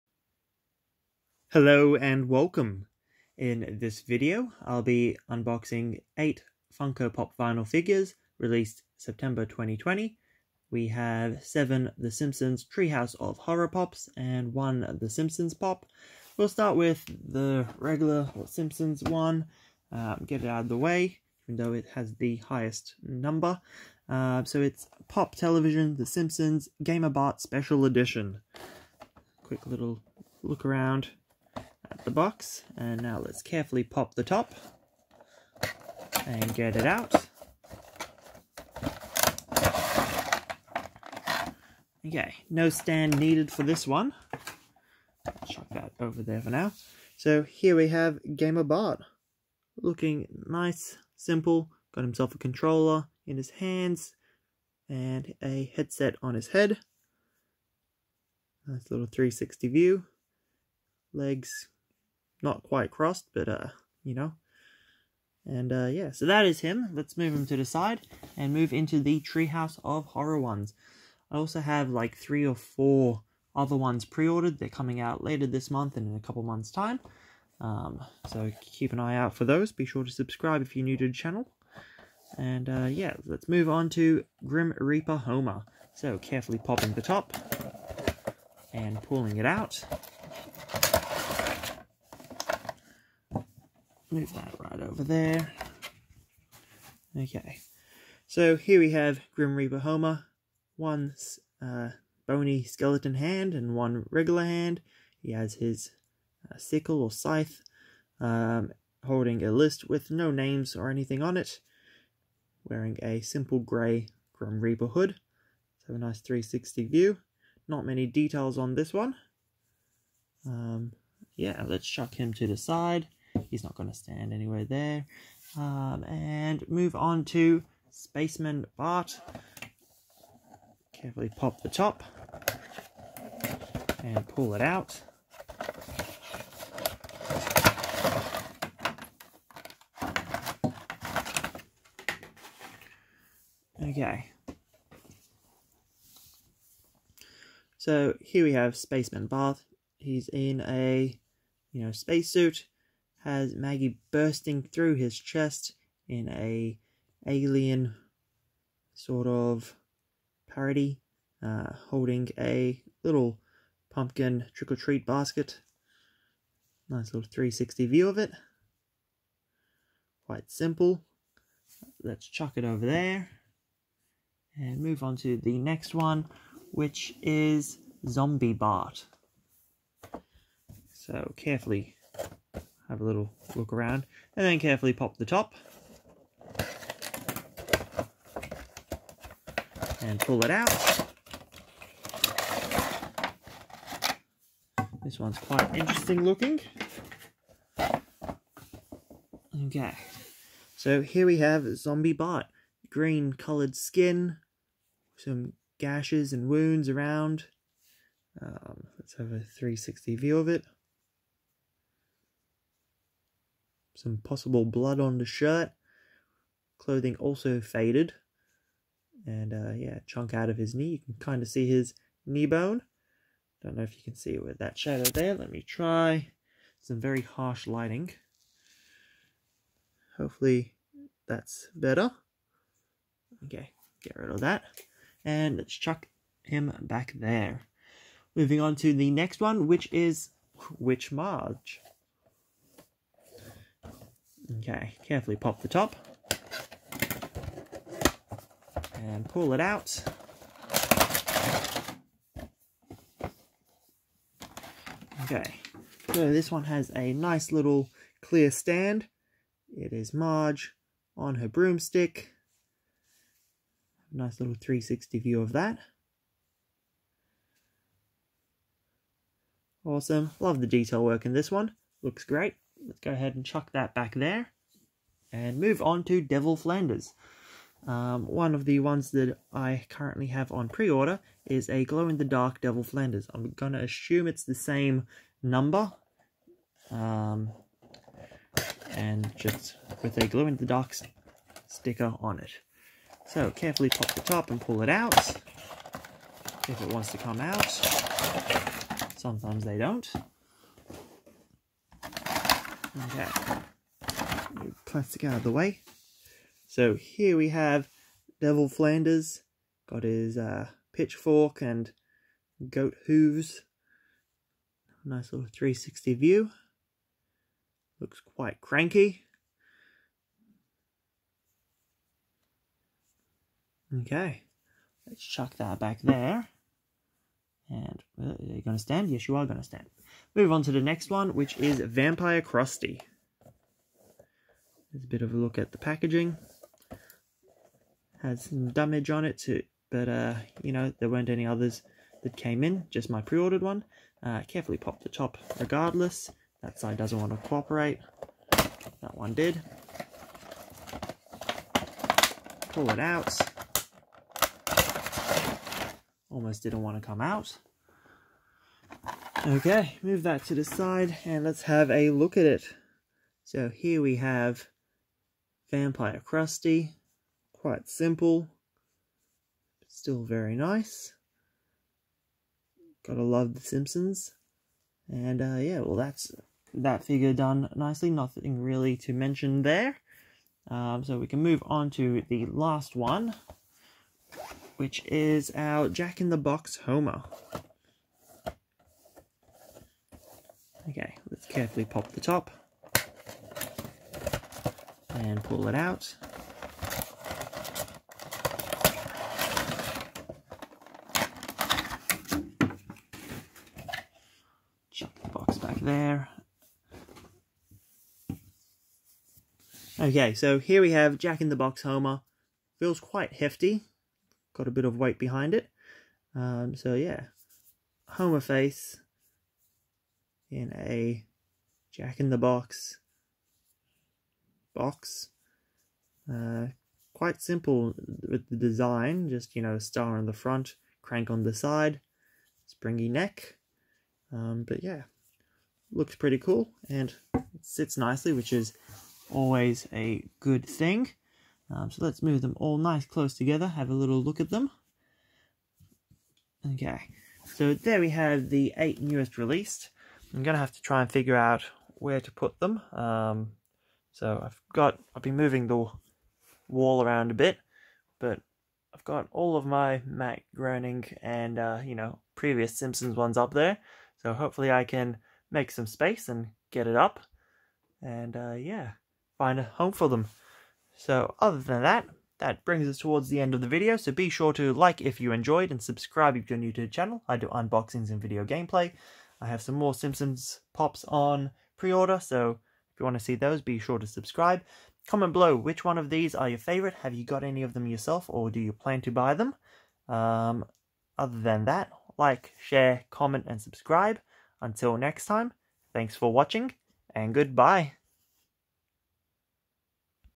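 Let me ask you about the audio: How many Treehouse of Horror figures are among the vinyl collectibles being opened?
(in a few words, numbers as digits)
7.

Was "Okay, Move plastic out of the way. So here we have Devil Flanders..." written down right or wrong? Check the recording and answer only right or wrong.
right.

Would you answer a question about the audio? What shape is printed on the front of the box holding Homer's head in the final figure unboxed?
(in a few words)
star.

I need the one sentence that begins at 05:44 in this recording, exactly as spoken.
Uh, carefully pop the top regardless.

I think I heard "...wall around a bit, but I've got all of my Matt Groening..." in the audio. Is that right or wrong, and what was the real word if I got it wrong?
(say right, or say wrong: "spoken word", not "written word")
right.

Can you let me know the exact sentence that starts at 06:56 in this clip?
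Um, so yeah, Homer face in a Jack in the Box box.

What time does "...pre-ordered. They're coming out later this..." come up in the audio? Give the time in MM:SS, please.
01:14.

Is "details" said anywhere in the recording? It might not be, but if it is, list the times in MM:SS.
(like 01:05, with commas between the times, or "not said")
01:58, 04:30.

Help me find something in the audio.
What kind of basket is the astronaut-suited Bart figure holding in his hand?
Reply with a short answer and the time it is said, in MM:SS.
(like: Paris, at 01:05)
pumpkin trick or treat basket, at 02:43.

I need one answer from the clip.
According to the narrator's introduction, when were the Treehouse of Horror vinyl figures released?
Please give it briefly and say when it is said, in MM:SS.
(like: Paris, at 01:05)
September 2020, at 00:08.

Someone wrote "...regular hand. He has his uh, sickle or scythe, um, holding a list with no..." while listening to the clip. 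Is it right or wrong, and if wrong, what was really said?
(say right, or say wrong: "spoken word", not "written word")
right.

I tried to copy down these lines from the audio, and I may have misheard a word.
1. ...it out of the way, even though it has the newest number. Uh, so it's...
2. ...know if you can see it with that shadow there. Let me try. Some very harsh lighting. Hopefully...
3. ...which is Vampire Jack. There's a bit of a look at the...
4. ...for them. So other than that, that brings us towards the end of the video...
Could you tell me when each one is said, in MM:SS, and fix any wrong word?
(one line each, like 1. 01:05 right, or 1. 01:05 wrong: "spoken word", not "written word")
1. 00:20 wrong: "highest", not "newest"
2. 03:43 right
3. 05:31 wrong: "Krusty", not "Jack"
4. 07:49 right.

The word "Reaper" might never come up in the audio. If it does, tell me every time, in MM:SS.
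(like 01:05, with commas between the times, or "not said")
01:24, 01:39, 01:54.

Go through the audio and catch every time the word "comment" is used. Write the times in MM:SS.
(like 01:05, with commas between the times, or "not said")
08:05, 08:13.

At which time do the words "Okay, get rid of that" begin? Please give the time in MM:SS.
03:53.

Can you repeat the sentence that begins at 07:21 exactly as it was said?
Um, so let's move them all nice close together, have a little look at them.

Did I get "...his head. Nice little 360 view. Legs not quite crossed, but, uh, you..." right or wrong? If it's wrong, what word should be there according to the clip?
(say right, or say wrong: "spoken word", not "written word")
right.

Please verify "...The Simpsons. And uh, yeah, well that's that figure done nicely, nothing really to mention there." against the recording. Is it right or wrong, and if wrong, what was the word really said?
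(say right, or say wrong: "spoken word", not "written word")
right.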